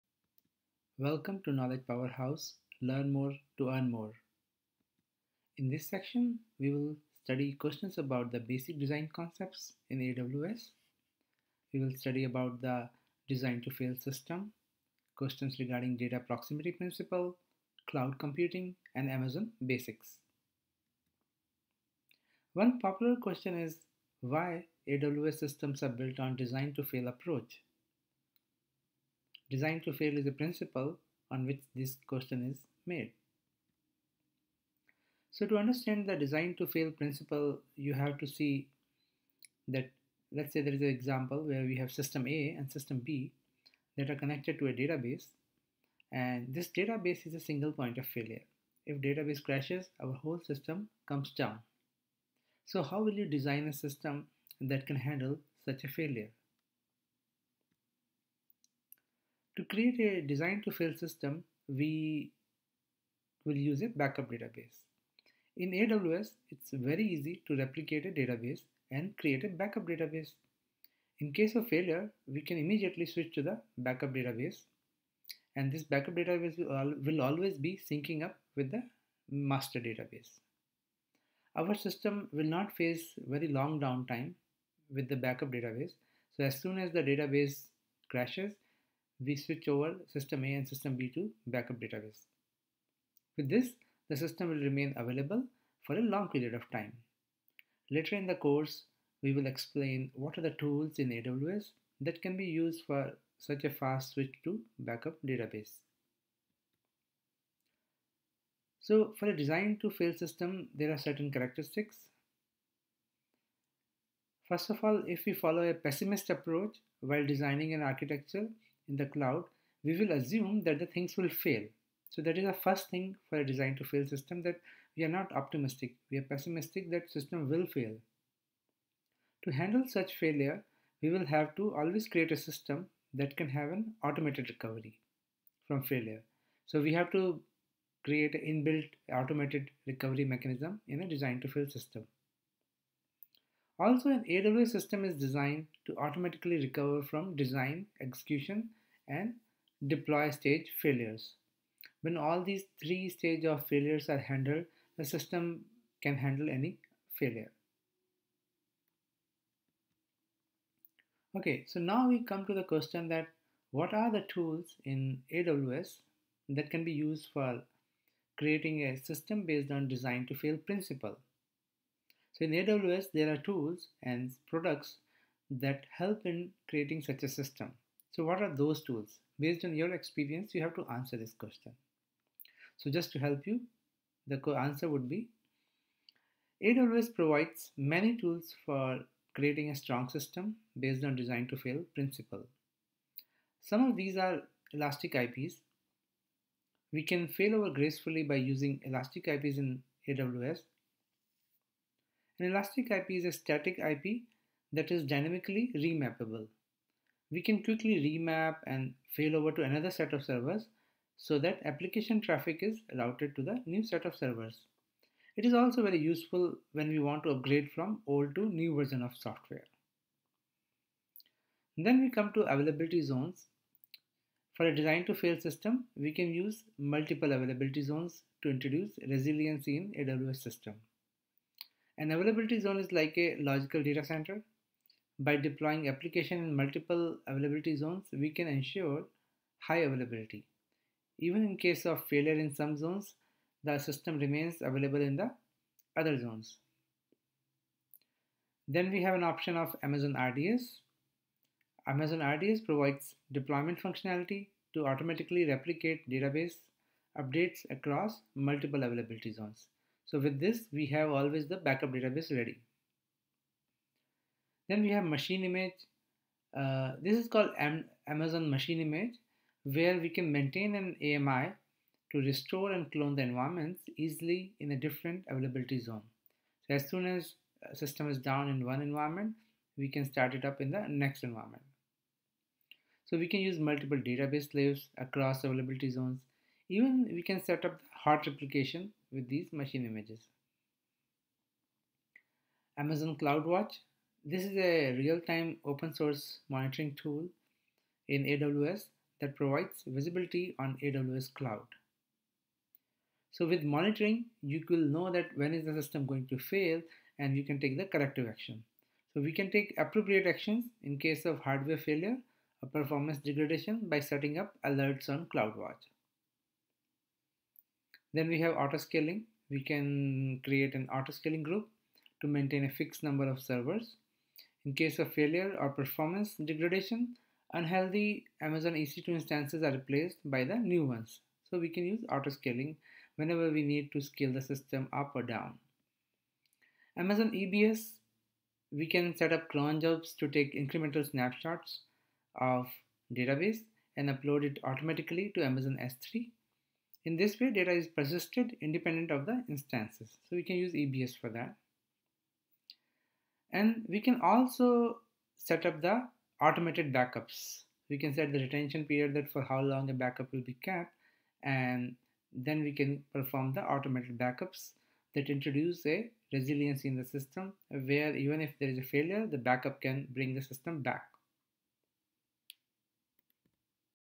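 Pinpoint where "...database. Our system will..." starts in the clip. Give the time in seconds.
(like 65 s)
79 s.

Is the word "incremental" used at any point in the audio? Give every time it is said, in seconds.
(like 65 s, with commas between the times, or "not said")
340 s.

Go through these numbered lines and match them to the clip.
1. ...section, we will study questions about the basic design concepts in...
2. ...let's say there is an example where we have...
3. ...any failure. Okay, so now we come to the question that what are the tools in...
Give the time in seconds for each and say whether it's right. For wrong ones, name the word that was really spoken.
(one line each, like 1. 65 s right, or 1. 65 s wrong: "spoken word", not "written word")
1. 5 s right
2. 40 s right
3. 156 s right.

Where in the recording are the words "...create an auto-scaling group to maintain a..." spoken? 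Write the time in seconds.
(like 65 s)
320 s.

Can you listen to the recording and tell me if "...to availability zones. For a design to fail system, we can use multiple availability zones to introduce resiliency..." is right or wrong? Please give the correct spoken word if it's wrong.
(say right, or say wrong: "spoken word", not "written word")
right.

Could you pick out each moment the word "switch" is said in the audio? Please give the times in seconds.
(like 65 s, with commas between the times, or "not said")
73 s, 89 s, 104 s.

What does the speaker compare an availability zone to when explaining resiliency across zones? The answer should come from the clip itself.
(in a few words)
A logical data center.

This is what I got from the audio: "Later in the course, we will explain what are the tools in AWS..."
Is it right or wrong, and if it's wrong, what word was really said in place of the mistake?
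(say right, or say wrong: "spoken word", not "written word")
right.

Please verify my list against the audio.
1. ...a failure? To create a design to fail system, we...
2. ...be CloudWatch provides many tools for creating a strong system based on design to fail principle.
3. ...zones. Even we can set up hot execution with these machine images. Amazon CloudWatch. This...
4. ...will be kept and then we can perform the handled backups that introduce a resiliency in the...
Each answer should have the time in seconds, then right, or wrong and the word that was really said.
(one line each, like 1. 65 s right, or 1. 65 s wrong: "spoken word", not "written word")
1. 55 s right
2. 185 s wrong: "AWS", not "CloudWatch"
3. 285 s wrong: "replication", not "execution"
4. 360 s wrong: "automated", not "handled".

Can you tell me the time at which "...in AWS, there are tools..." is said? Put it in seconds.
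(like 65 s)
172 s.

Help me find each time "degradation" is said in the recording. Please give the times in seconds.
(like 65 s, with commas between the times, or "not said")
313 s, 326 s.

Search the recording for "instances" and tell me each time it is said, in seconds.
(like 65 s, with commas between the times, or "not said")
329 s, 349 s.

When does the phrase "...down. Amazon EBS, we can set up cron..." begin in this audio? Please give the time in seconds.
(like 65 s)
335 s.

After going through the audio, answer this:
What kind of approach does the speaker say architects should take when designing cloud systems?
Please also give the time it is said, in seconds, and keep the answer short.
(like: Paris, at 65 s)
Pessimist approach, at 115 s.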